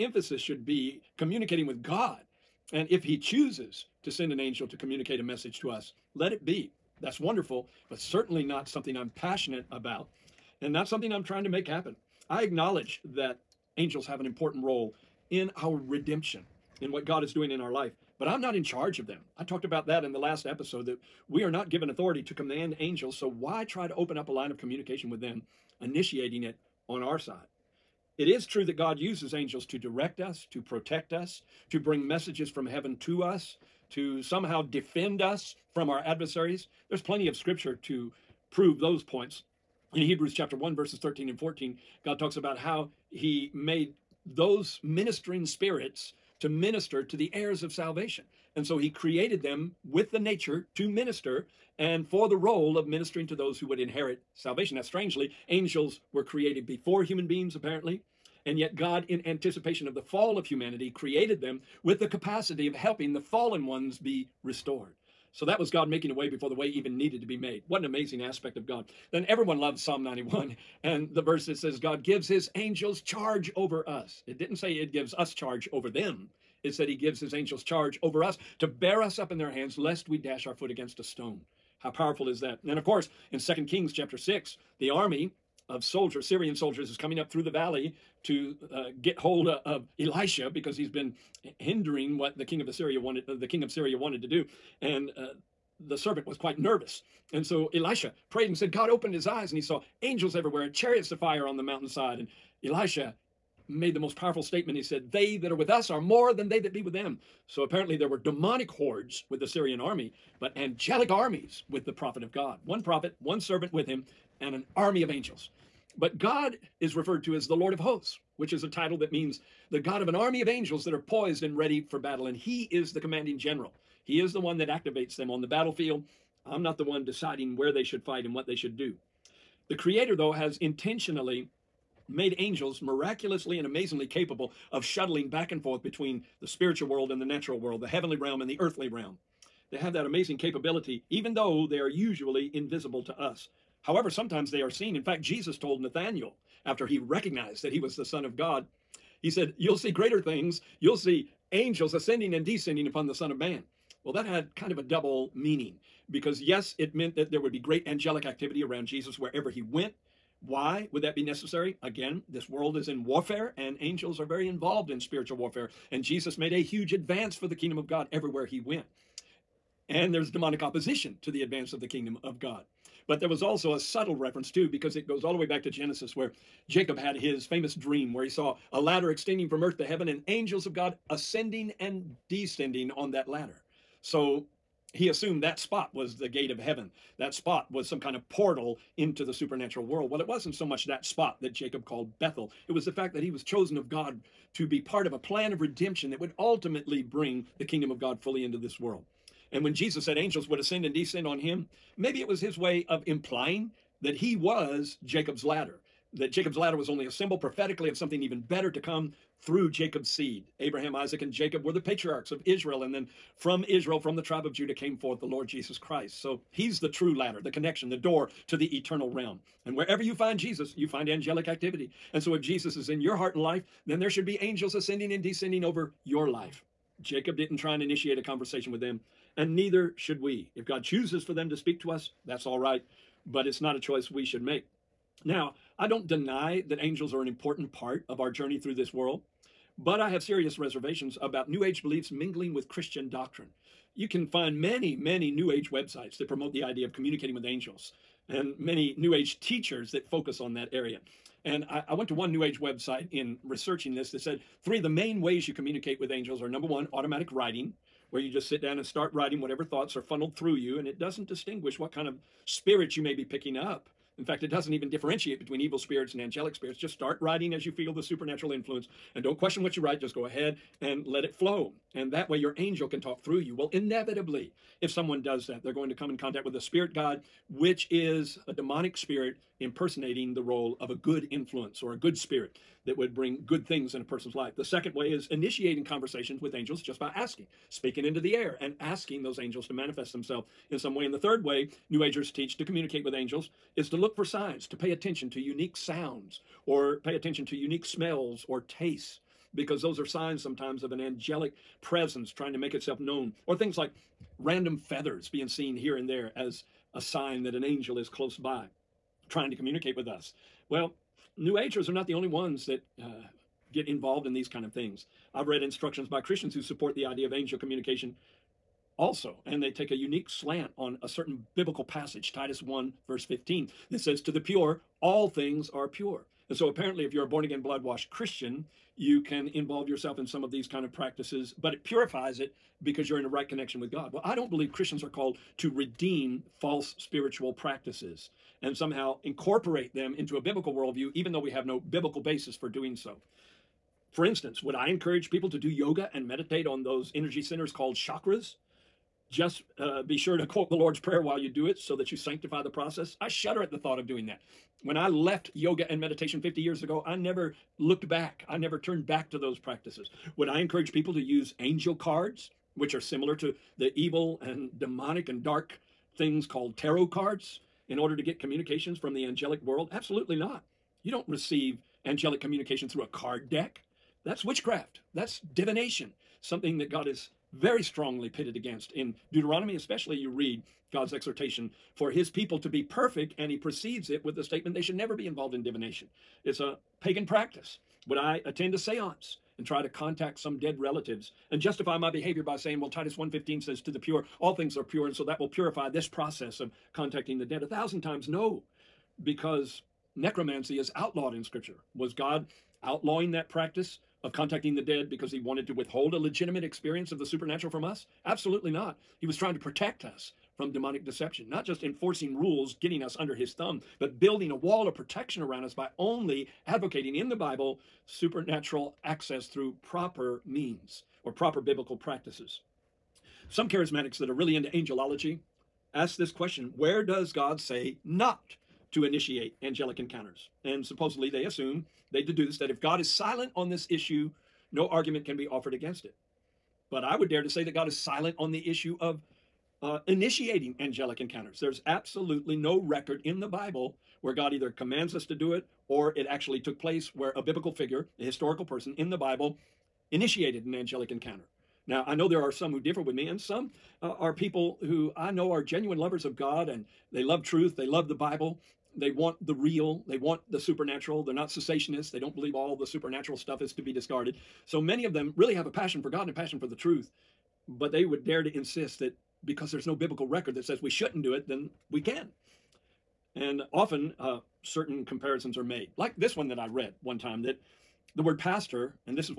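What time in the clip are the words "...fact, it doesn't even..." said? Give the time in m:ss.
4:24.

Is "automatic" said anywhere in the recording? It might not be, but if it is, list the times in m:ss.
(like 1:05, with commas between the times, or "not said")
4:16.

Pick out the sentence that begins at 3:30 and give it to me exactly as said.
Abraham, Isaac, and Jacob were the patriarchs of Israel.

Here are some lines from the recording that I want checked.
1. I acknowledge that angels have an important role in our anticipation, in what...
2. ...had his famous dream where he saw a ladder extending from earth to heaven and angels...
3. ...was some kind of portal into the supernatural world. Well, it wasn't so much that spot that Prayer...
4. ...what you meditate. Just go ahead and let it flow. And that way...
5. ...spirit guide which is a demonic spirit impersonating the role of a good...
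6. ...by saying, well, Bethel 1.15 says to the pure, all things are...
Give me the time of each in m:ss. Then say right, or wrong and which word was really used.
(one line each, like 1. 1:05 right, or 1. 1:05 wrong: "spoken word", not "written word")
1. 0:12 wrong: "redemption", not "anticipation"
2. 2:56 right
3. 3:07 wrong: "Jacob", not "Prayer"
4. 4:29 wrong: "write", not "meditate"
5. 4:36 right
6. 6:32 wrong: "Titus", not "Bethel".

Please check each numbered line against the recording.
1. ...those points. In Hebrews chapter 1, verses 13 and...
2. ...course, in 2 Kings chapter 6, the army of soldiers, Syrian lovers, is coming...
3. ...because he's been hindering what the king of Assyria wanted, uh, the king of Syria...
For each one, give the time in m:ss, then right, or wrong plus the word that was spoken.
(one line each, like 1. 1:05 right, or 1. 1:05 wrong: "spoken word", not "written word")
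1. 0:38 right
2. 1:22 wrong: "soldiers", not "lovers"
3. 1:30 right.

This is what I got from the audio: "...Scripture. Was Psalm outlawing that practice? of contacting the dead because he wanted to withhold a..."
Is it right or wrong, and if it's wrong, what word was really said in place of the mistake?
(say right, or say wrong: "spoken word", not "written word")
wrong: "God", not "Psalm".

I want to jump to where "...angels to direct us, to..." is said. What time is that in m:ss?
0:29.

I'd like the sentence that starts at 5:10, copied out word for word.
Well, New Agers are not the only ones that uh, get involved in these kind of things.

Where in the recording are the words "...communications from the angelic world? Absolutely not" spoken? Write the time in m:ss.
6:08.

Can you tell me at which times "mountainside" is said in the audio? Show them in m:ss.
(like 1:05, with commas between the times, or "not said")
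1:41.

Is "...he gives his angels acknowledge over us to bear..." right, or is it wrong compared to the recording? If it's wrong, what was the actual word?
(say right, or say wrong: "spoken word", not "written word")
wrong: "charge", not "acknowledge".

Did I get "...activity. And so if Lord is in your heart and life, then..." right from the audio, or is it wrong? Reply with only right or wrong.
wrong.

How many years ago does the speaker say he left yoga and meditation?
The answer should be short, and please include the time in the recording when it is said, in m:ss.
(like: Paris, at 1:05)
50, at 5:56.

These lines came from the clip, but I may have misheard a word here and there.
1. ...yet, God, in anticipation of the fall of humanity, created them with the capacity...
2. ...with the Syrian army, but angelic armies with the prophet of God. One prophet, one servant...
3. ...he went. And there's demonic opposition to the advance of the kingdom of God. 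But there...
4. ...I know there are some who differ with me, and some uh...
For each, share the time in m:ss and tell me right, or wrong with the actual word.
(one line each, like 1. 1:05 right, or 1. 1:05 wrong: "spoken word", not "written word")
1. 0:58 right
2. 1:49 right
3. 2:48 right
4. 7:32 right.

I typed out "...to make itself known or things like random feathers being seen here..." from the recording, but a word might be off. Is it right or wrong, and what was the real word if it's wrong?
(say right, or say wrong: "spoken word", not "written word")
right.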